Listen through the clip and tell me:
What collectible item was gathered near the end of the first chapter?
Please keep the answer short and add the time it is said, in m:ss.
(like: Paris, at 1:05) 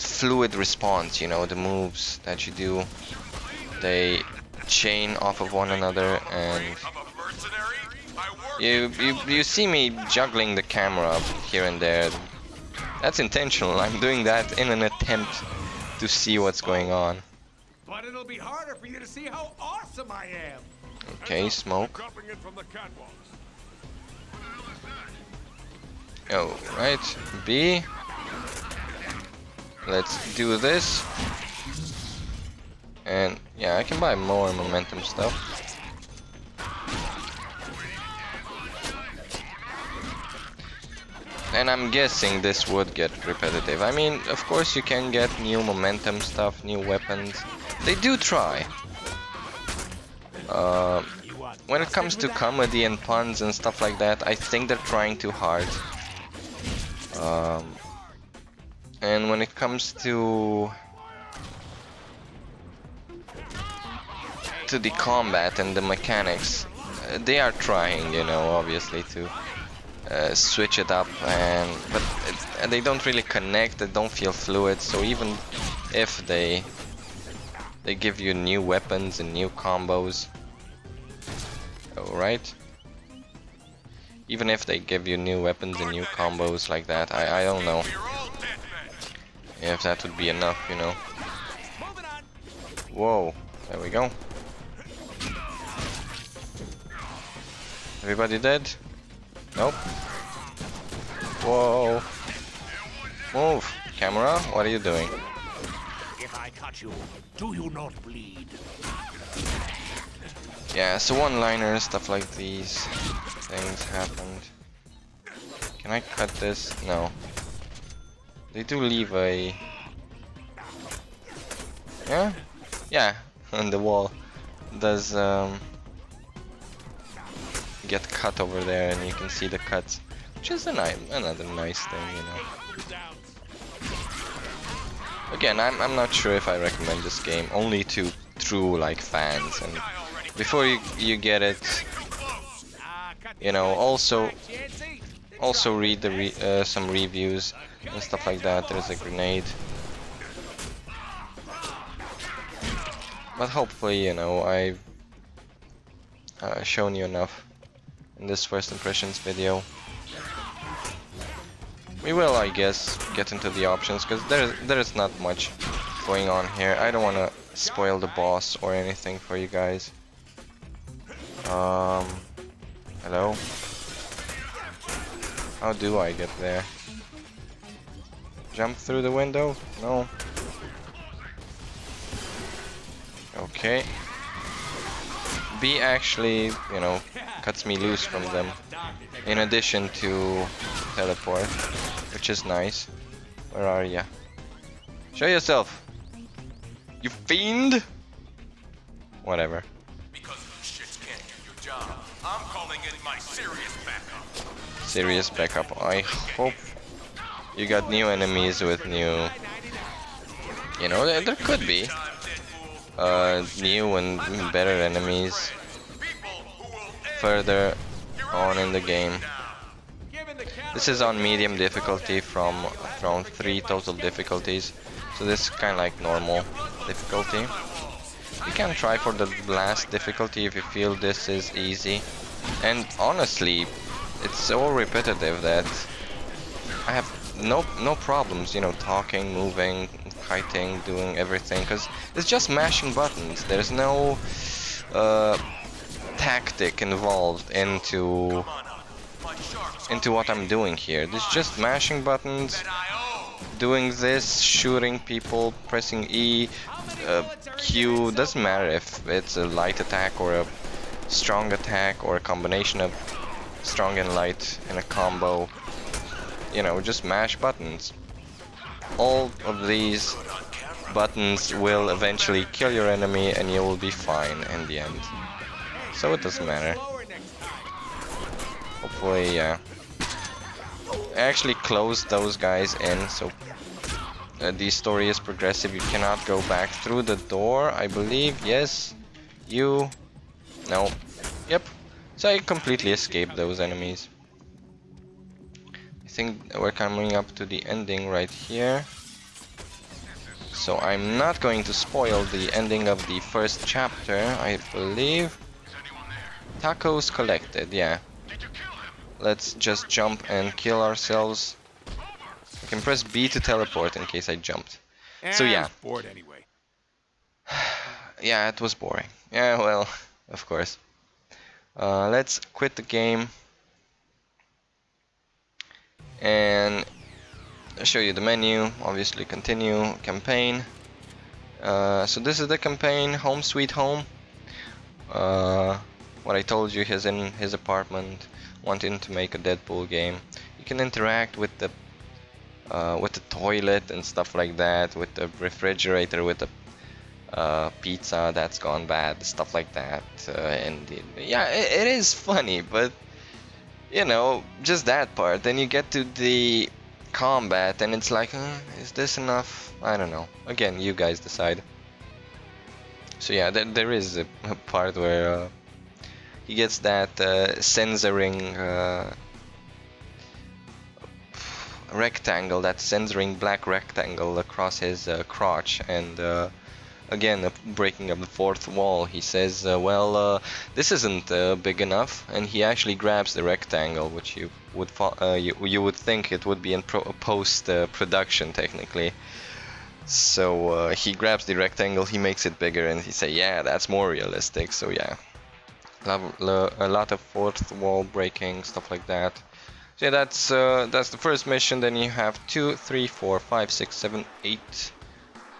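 Tacos, at 5:06.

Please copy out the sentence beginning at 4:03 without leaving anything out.
There's no uh, tactic involved into into what I'm doing here.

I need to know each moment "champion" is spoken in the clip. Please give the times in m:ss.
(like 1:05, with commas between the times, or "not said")
not said.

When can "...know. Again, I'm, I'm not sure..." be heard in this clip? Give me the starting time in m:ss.
2:12.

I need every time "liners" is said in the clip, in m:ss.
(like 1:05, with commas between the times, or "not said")
1:51.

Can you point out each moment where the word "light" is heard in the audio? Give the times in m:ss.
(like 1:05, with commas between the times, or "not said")
4:19, 4:24.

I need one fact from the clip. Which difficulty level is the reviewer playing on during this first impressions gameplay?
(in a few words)
Medium.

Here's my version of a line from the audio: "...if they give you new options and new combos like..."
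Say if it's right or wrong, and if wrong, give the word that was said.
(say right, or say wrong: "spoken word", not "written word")
wrong: "weapons", not "options".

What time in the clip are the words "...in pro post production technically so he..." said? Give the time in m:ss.
6:26.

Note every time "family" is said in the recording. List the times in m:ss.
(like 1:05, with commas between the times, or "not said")
not said.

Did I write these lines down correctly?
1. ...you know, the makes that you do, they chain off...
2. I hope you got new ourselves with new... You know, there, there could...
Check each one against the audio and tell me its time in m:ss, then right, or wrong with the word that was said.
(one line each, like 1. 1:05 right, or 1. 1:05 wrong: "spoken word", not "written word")
1. 0:01 wrong: "moves", not "makes"
2. 3:25 wrong: "enemies", not "ourselves".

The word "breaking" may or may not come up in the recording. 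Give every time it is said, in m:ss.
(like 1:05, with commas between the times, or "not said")
6:17, 6:38.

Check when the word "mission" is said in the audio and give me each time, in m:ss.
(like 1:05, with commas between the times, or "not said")
6:41.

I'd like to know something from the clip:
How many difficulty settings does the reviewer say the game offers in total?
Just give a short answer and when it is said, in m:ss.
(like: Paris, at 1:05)
3, at 3:43.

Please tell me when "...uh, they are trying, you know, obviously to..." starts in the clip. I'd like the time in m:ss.
1:07.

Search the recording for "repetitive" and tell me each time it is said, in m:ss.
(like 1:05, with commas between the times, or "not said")
0:43, 3:54.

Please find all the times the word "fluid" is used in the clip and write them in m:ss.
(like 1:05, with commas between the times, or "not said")
0:00, 1:14.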